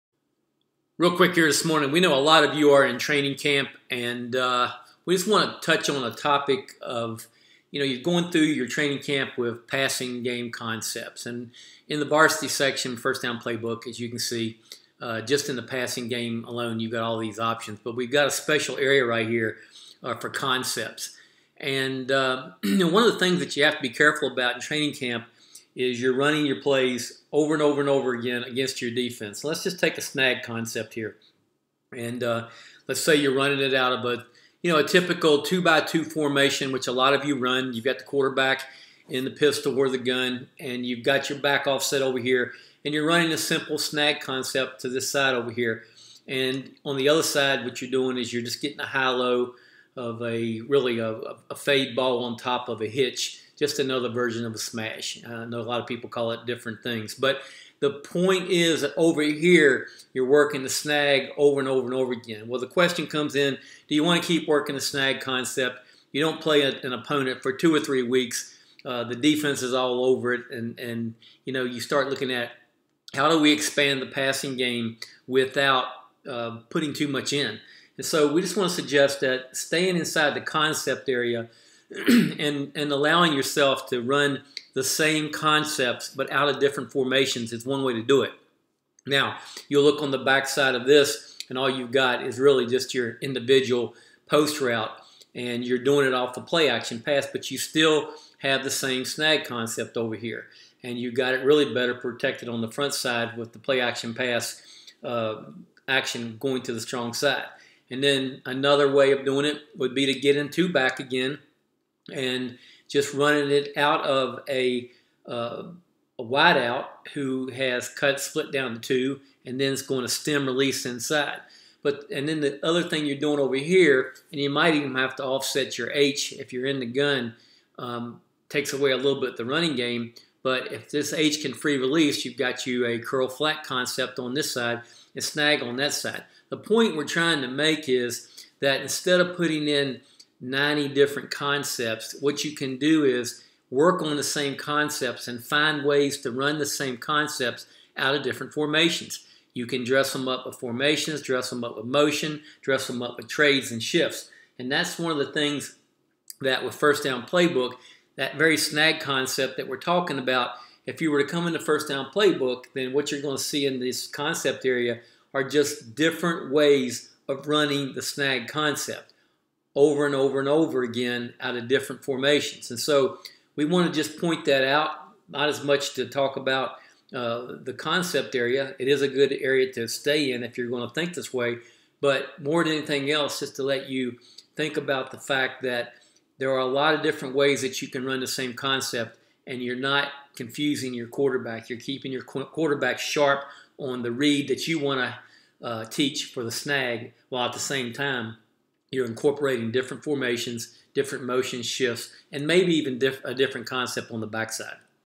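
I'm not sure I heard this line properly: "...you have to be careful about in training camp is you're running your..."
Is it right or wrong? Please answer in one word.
right.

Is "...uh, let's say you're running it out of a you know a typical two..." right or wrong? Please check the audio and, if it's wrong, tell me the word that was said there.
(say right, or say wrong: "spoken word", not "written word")
right.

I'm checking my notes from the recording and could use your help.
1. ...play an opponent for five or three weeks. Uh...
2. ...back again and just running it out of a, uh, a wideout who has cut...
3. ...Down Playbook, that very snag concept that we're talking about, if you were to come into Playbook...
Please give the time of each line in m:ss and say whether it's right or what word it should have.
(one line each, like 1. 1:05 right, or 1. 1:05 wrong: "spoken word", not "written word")
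1. 1:06 wrong: "two", not "five"
2. 1:50 right
3. 2:37 wrong: "First", not "Playbook".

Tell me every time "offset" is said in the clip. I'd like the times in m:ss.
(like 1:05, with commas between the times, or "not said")
0:41, 2:05.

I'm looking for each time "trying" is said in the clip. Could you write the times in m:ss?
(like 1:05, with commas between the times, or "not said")
2:17.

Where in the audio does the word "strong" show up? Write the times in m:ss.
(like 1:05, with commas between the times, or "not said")
1:46.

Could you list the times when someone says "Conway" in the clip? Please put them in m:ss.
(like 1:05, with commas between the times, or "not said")
not said.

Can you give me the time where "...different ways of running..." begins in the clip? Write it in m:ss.
2:45.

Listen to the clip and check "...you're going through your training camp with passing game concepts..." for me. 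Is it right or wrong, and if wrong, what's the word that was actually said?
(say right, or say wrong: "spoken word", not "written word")
right.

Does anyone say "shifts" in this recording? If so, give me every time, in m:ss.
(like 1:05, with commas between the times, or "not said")
2:33, 3:21.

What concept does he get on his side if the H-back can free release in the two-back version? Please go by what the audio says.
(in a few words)
curl flat.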